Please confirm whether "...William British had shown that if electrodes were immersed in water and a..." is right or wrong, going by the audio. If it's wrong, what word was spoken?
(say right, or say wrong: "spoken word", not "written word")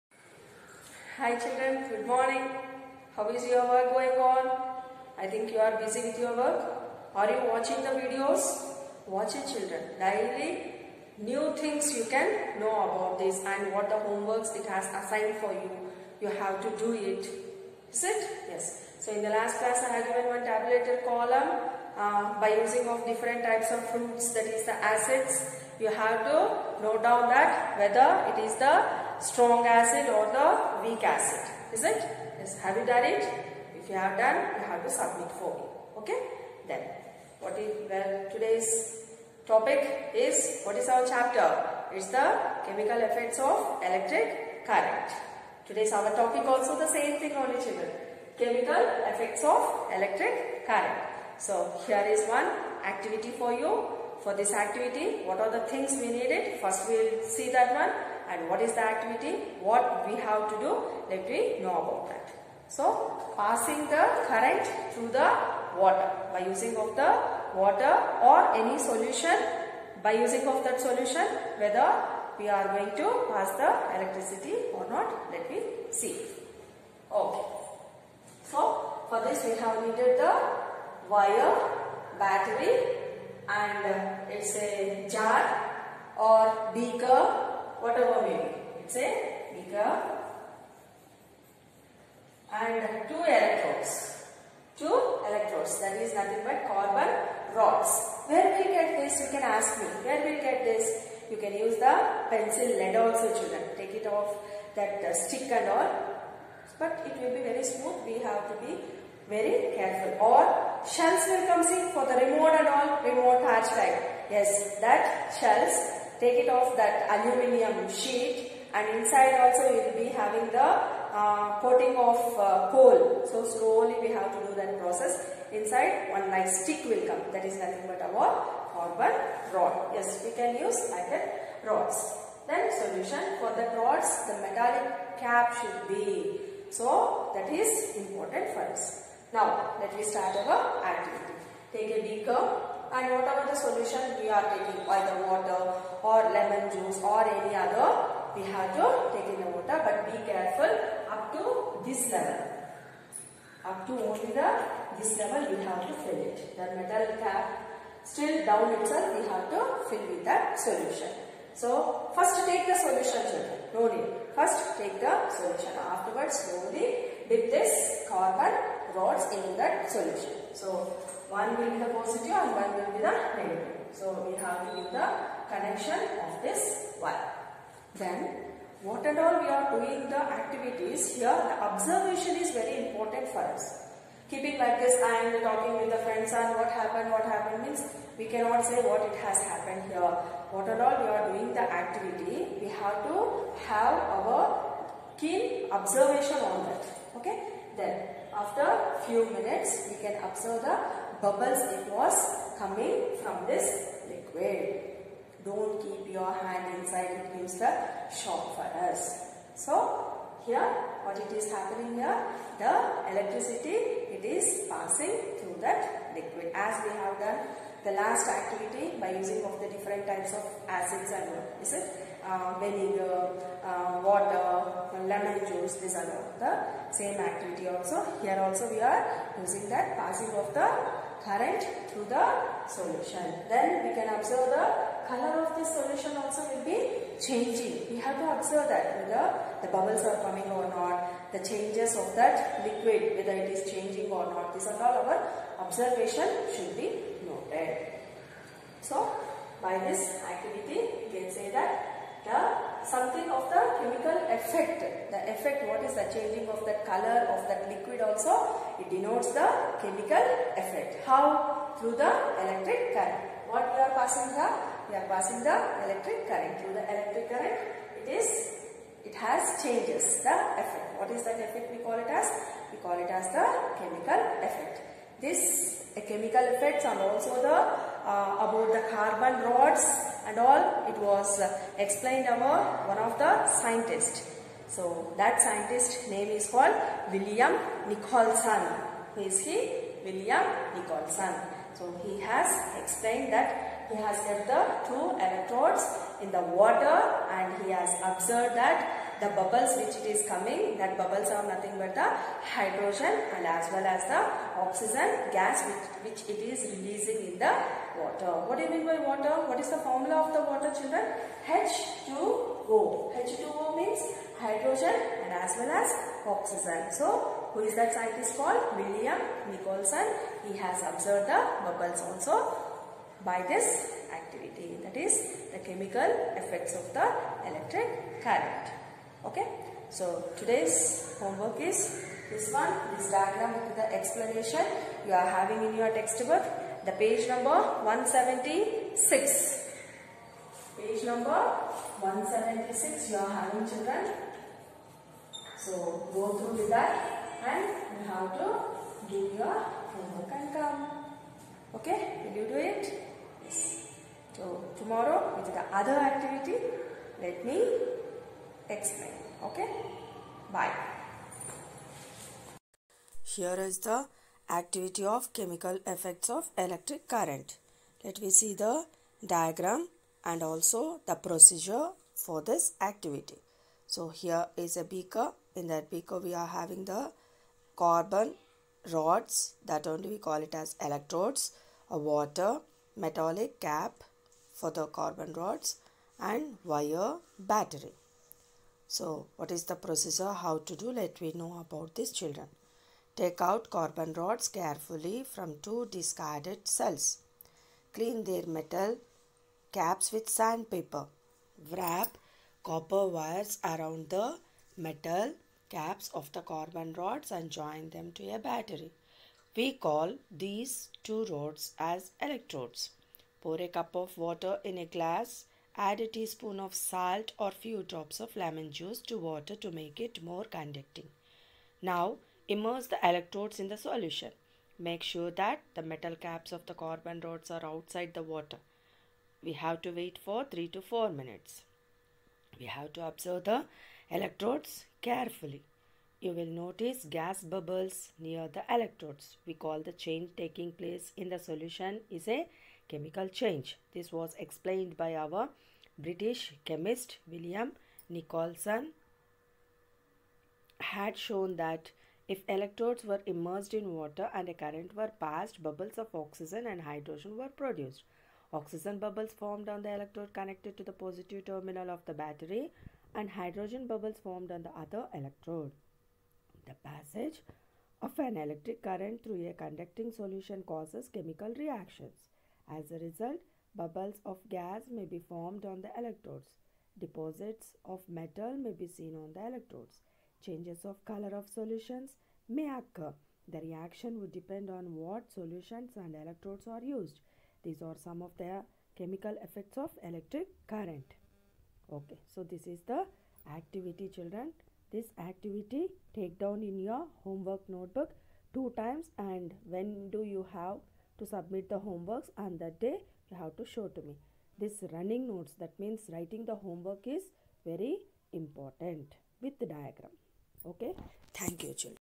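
wrong: "Nicholson", not "British".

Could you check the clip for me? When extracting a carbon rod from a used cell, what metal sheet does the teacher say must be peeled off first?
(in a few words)
aluminium sheet.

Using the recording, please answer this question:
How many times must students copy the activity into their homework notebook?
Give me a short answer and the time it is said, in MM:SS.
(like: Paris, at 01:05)
2 times, at 08:18.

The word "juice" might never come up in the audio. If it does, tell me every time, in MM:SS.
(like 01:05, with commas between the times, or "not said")
02:26, 03:45, 06:58.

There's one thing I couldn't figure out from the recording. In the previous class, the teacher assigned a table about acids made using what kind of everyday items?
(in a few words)
fruits.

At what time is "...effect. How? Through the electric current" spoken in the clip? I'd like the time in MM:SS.
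04:20.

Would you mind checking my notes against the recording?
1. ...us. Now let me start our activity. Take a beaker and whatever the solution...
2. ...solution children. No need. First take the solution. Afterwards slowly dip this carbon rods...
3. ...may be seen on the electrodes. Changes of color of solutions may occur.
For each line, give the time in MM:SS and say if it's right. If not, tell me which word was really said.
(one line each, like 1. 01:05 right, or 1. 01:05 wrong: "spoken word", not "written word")
1. 02:18 right
2. 02:42 right
3. 07:58 right.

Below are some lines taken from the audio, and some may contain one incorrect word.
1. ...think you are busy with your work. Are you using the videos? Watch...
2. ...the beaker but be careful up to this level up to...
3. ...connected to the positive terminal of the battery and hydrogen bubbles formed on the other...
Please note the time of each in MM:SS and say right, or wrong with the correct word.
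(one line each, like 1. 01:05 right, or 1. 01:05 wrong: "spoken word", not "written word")
1. 00:05 wrong: "watching", not "using"
2. 02:29 wrong: "water", not "beaker"
3. 07:40 right.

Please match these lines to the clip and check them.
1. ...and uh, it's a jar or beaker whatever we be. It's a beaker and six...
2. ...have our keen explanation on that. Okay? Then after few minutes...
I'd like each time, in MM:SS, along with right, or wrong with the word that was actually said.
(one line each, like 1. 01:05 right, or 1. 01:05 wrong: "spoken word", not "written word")
1. 01:23 wrong: "two", not "six"
2. 03:13 wrong: "observation", not "explanation".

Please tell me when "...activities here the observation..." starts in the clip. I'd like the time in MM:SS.
03:00.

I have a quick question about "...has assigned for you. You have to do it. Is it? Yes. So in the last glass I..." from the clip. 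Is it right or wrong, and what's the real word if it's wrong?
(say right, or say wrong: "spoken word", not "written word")
wrong: "class", not "glass".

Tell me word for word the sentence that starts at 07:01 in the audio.
Now immerse the electrodes in the solution.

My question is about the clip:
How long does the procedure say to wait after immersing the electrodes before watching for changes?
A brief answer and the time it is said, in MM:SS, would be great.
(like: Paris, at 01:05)
3 to 4 minutes, at 07:10.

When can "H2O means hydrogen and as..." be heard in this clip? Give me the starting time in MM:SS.
05:13.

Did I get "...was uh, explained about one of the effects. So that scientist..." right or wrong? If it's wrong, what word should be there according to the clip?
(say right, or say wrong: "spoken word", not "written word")
wrong: "scientists", not "effects".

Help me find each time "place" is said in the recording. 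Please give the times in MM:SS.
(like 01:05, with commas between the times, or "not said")
07:20.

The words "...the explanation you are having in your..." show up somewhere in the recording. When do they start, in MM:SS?
05:33.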